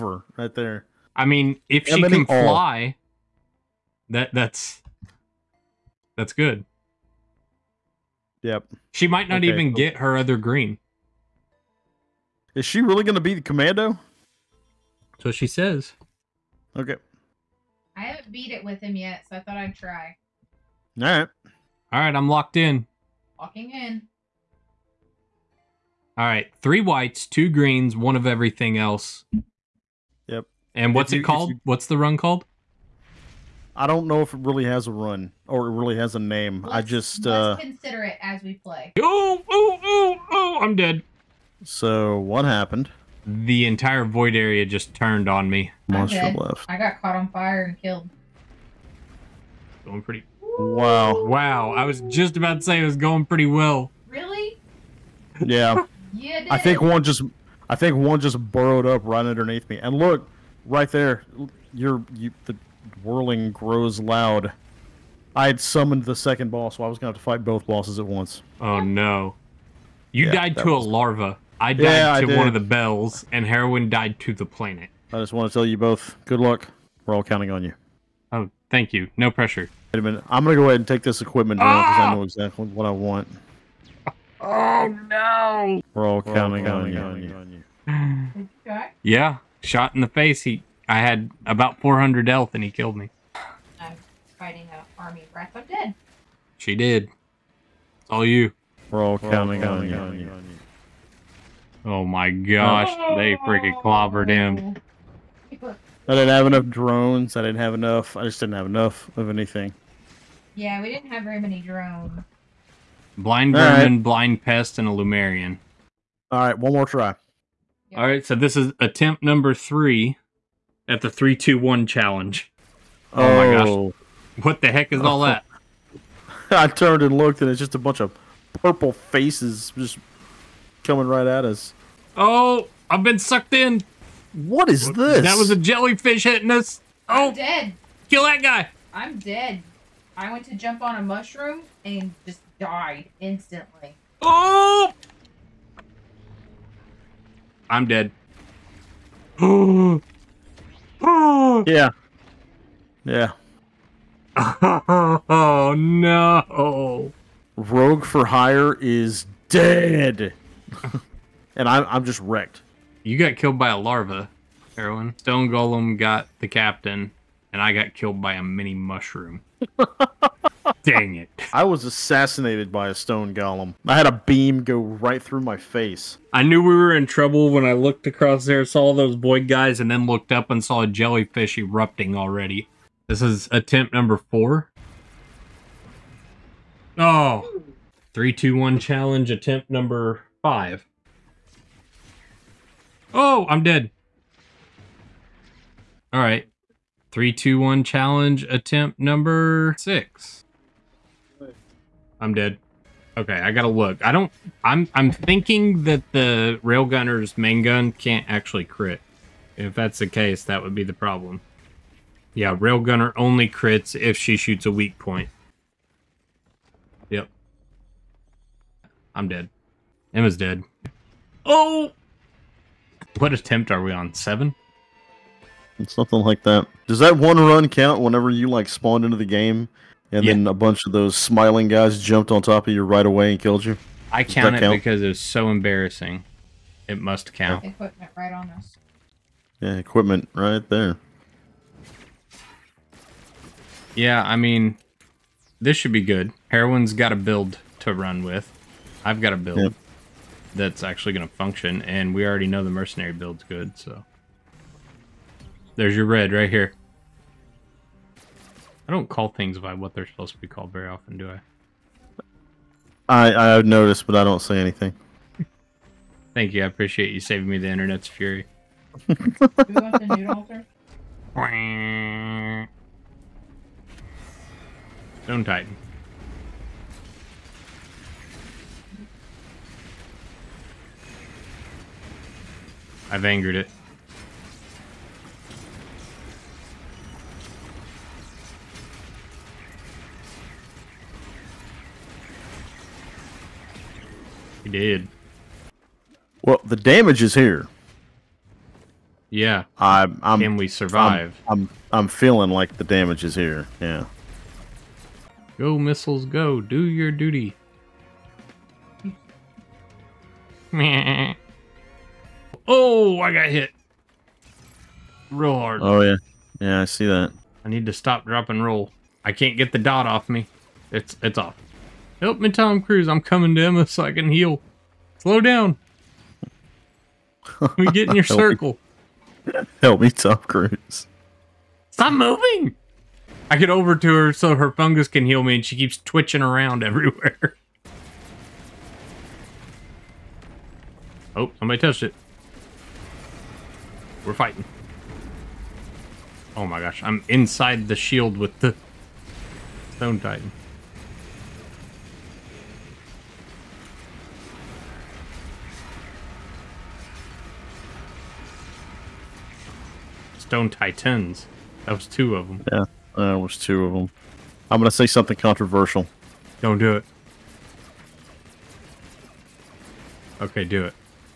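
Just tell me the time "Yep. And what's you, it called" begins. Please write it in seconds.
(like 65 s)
30 s.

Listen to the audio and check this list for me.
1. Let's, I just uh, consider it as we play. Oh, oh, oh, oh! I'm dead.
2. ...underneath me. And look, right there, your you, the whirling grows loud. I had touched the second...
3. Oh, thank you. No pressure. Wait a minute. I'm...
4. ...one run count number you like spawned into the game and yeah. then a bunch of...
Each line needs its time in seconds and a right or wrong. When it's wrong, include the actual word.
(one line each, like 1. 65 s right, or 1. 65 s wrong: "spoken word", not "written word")
1. 36 s right
2. 59 s wrong: "summoned", not "touched"
3. 78 s right
4. 227 s wrong: "whenever", not "number".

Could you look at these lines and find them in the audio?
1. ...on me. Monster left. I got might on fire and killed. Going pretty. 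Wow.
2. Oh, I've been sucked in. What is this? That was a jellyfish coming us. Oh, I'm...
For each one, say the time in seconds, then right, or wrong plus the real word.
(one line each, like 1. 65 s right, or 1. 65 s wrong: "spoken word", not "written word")
1. 45 s wrong: "caught", not "might"
2. 132 s wrong: "hitting", not "coming".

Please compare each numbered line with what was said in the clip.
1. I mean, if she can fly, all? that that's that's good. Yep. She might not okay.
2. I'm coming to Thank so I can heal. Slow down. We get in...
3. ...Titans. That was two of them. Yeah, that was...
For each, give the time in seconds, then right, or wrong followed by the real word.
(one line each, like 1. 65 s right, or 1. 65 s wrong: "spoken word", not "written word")
1. 1 s right
2. 323 s wrong: "Emma", not "Thank"
3. 360 s right.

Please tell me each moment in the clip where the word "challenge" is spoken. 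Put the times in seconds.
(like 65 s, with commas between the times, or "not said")
121 s, 188 s, 197 s.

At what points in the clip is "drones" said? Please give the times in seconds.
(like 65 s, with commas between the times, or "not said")
106 s, 111 s.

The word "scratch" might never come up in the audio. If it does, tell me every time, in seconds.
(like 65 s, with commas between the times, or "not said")
not said.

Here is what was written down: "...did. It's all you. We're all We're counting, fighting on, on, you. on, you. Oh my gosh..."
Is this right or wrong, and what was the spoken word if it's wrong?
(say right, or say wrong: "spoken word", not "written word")
wrong: "counting", not "fighting".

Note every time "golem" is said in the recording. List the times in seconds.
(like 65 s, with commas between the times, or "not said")
165 s, 173 s.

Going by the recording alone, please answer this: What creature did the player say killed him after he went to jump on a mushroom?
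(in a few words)
a mini mushroom.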